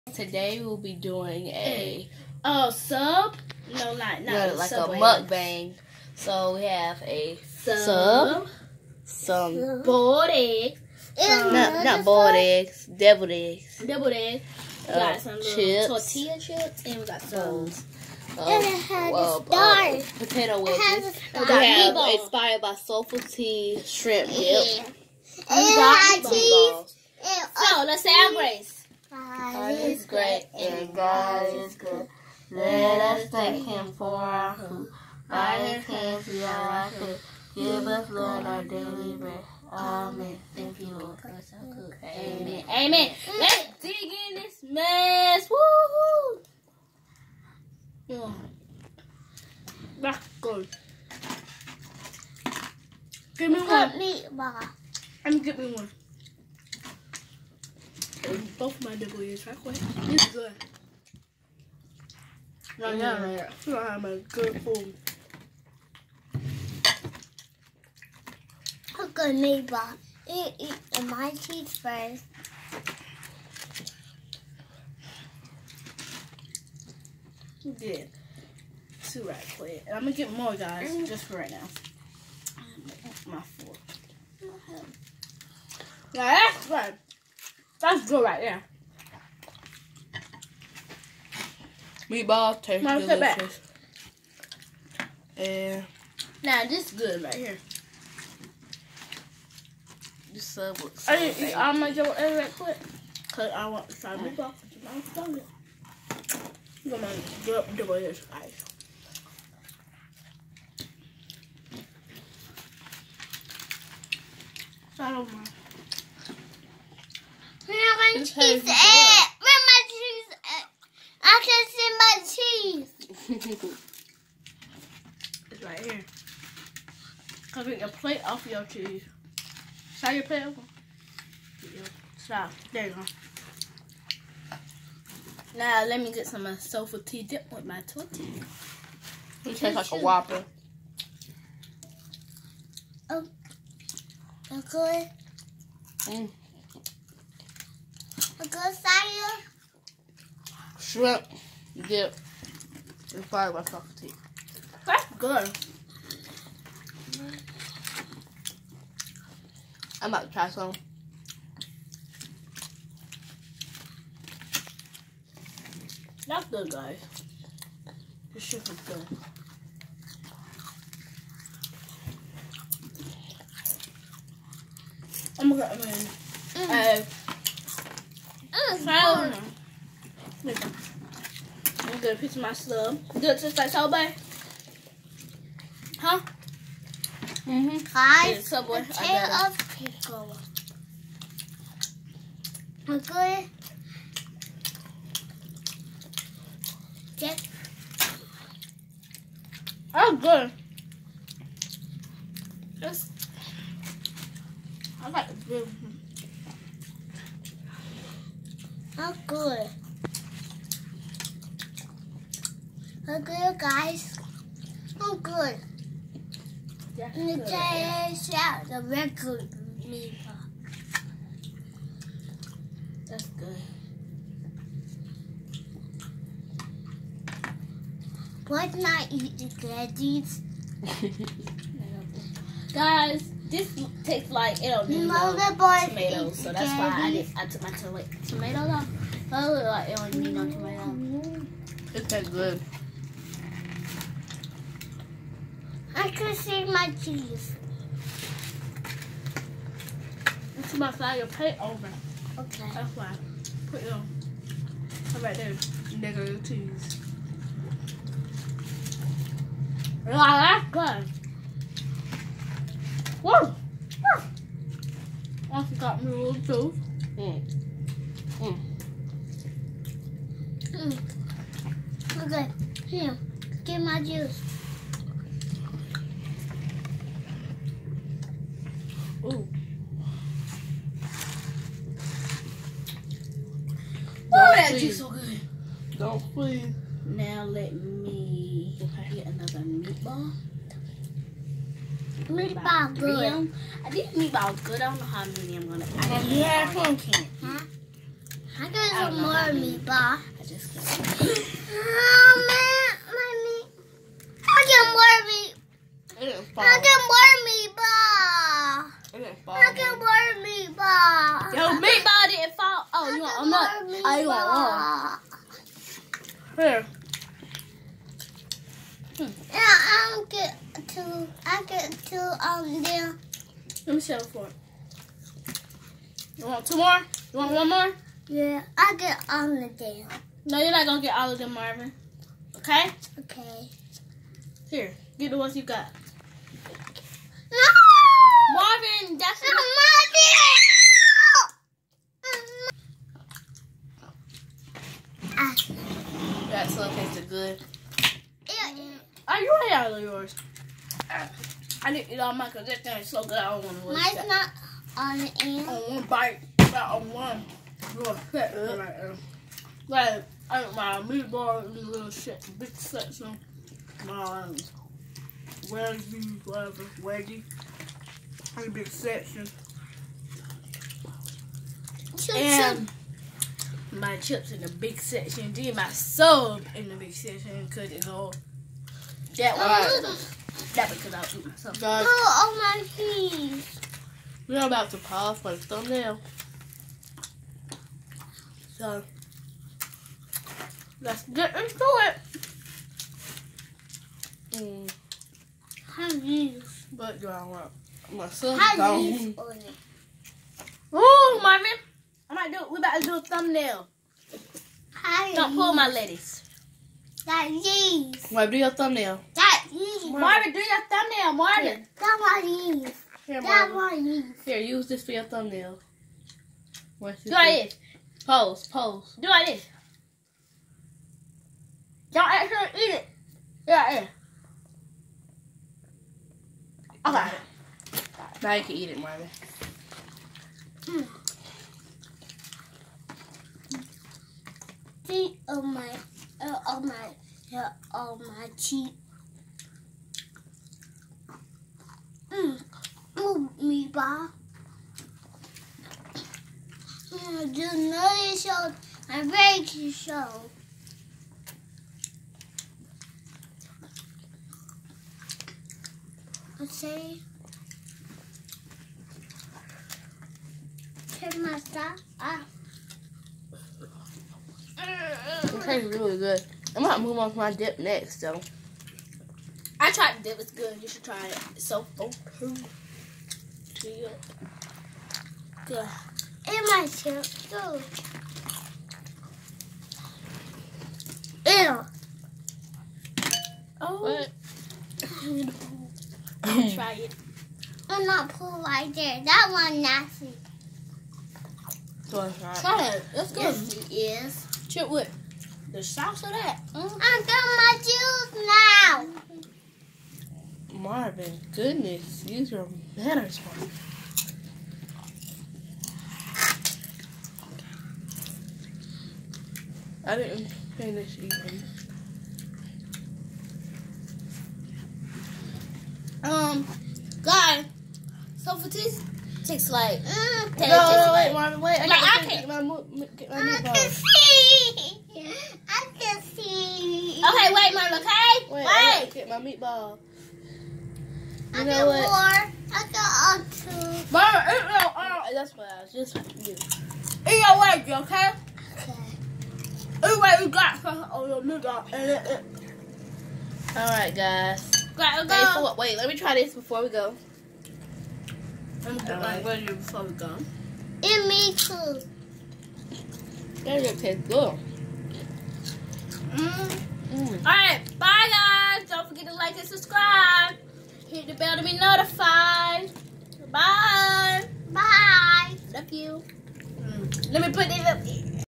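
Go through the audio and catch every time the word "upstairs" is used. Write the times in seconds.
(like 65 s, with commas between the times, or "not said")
not said.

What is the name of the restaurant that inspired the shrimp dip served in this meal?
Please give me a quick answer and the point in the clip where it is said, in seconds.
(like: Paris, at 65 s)
Soulful T, at 22 s.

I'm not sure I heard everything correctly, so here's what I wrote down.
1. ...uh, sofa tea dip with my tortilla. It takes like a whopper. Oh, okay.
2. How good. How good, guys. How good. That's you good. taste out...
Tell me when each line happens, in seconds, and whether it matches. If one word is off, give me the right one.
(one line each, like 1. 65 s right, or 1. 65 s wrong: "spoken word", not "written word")
1. 136 s wrong: "tastes", not "takes"
2. 209 s right.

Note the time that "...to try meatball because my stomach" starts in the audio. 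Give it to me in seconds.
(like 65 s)
103 s.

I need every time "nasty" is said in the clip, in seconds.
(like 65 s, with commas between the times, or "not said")
489 s.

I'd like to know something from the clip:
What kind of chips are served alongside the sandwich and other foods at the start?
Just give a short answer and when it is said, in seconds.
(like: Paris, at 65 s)
tortilla chips, at 15 s.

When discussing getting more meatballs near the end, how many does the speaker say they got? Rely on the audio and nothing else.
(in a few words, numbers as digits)
2.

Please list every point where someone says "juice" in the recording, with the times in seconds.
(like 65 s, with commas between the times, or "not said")
274 s, 284 s, 497 s.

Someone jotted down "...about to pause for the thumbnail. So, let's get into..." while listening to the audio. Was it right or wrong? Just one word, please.
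right.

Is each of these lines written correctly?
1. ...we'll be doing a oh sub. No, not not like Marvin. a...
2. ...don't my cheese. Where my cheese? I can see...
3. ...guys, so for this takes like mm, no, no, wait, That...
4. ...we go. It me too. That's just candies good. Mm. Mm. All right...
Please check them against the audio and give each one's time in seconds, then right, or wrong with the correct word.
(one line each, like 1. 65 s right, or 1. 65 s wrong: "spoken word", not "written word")
1. 0 s wrong: "Subway", not "Marvin"
2. 115 s right
3. 517 s wrong: "Robin", not "That"
4. 550 s wrong: "tastes", not "candies".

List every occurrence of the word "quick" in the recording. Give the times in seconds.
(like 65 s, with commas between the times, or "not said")
59 s, 79 s, 102 s.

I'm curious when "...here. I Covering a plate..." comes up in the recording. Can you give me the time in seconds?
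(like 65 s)
125 s.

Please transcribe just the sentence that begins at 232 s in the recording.
guys, this tastes like it don't need no, no tomatoes, so that's candy.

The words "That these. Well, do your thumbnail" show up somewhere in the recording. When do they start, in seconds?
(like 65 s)
407 s.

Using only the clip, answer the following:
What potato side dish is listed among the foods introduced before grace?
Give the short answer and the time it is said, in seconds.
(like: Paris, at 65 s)
potato wedges, at 20 s.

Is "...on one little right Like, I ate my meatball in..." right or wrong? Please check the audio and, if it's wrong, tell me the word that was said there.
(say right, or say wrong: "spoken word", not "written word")
right.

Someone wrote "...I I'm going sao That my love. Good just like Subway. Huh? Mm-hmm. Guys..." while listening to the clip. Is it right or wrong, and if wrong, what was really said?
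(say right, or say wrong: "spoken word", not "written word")
wrong: "Good", not "That".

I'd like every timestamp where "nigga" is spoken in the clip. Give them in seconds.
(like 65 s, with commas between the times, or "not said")
255 s, 541 s.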